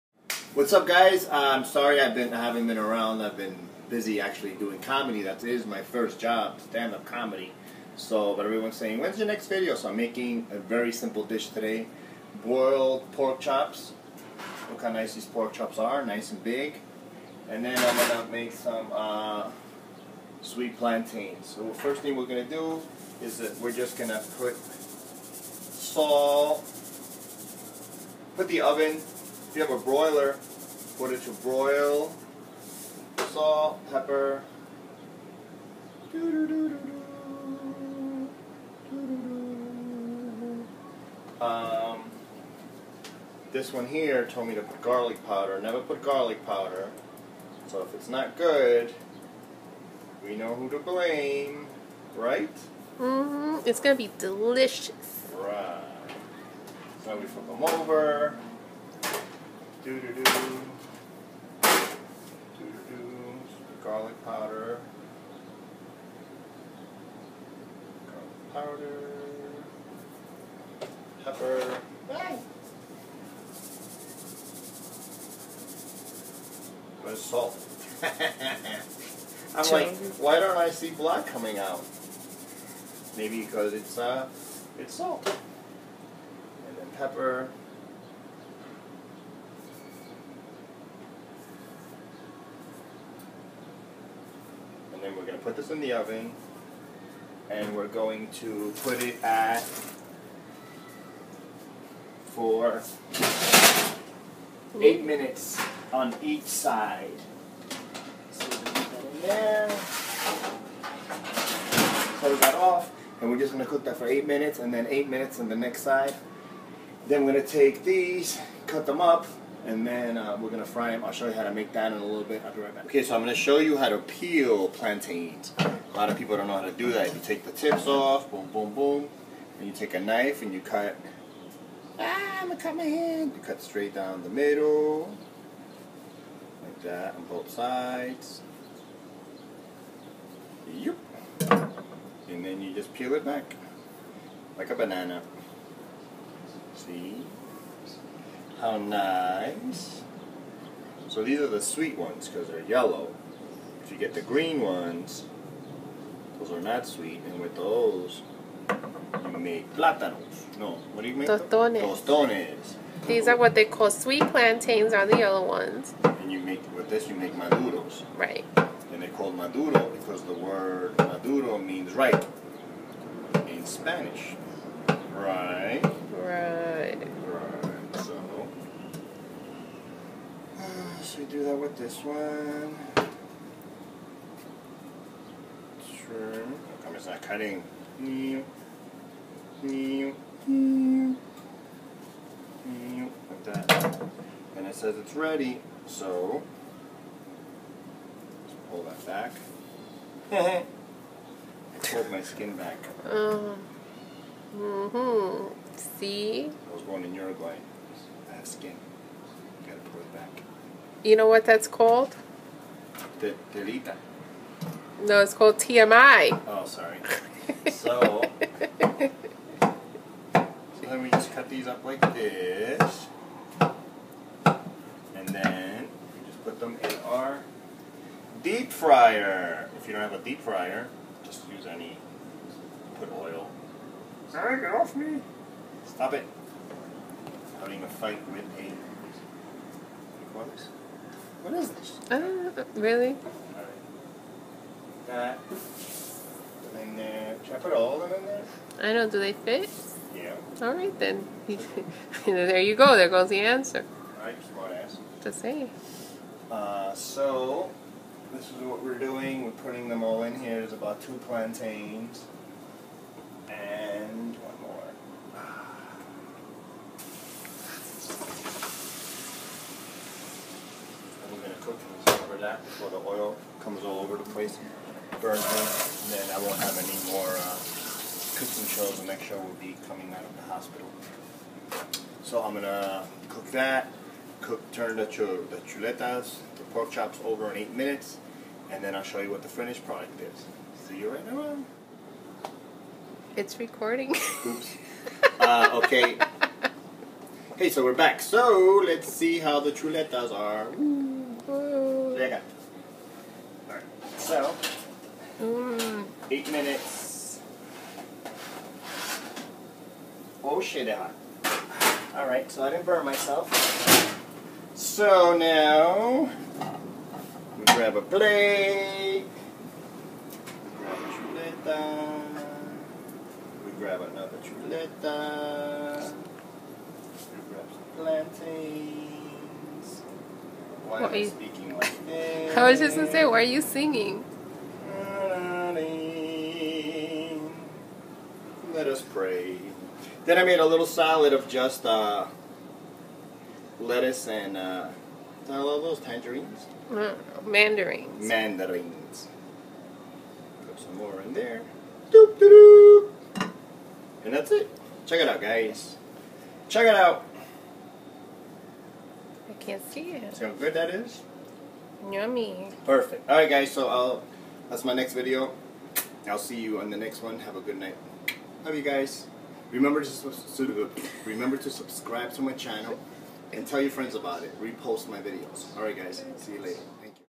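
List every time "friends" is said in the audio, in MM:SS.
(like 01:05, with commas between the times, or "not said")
06:13.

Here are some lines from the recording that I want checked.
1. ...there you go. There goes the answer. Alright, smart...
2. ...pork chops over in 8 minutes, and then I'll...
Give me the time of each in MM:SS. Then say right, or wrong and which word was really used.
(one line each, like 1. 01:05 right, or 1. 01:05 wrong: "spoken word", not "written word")
1. 04:12 right
2. 04:46 right.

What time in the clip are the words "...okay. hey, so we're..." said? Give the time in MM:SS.
04:55.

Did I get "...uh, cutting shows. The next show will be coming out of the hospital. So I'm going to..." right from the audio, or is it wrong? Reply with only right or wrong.
wrong.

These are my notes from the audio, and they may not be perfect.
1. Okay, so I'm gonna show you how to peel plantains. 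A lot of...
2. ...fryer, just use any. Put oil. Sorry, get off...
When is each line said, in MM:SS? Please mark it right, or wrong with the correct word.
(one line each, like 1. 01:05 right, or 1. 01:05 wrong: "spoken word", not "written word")
1. 02:02 right
2. 03:50 right.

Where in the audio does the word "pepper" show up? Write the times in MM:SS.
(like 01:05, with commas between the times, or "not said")
00:33, 01:11, 01:26.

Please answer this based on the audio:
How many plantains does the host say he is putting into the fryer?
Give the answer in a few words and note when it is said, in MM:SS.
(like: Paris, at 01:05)
2, at 04:21.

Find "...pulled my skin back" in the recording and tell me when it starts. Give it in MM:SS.
03:21.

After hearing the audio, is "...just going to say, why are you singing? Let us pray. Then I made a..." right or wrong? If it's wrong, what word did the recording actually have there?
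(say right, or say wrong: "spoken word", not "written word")
right.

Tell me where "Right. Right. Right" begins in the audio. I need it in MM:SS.
02:55.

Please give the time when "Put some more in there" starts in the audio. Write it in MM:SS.
05:50.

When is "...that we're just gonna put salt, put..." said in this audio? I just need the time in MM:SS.
00:23.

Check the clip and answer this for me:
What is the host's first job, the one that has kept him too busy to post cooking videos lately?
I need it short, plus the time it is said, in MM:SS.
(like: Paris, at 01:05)
Stand-up comedy, at 00:06.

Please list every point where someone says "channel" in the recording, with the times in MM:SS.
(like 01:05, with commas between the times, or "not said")
06:12.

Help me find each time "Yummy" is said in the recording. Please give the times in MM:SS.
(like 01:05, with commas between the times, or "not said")
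06:02.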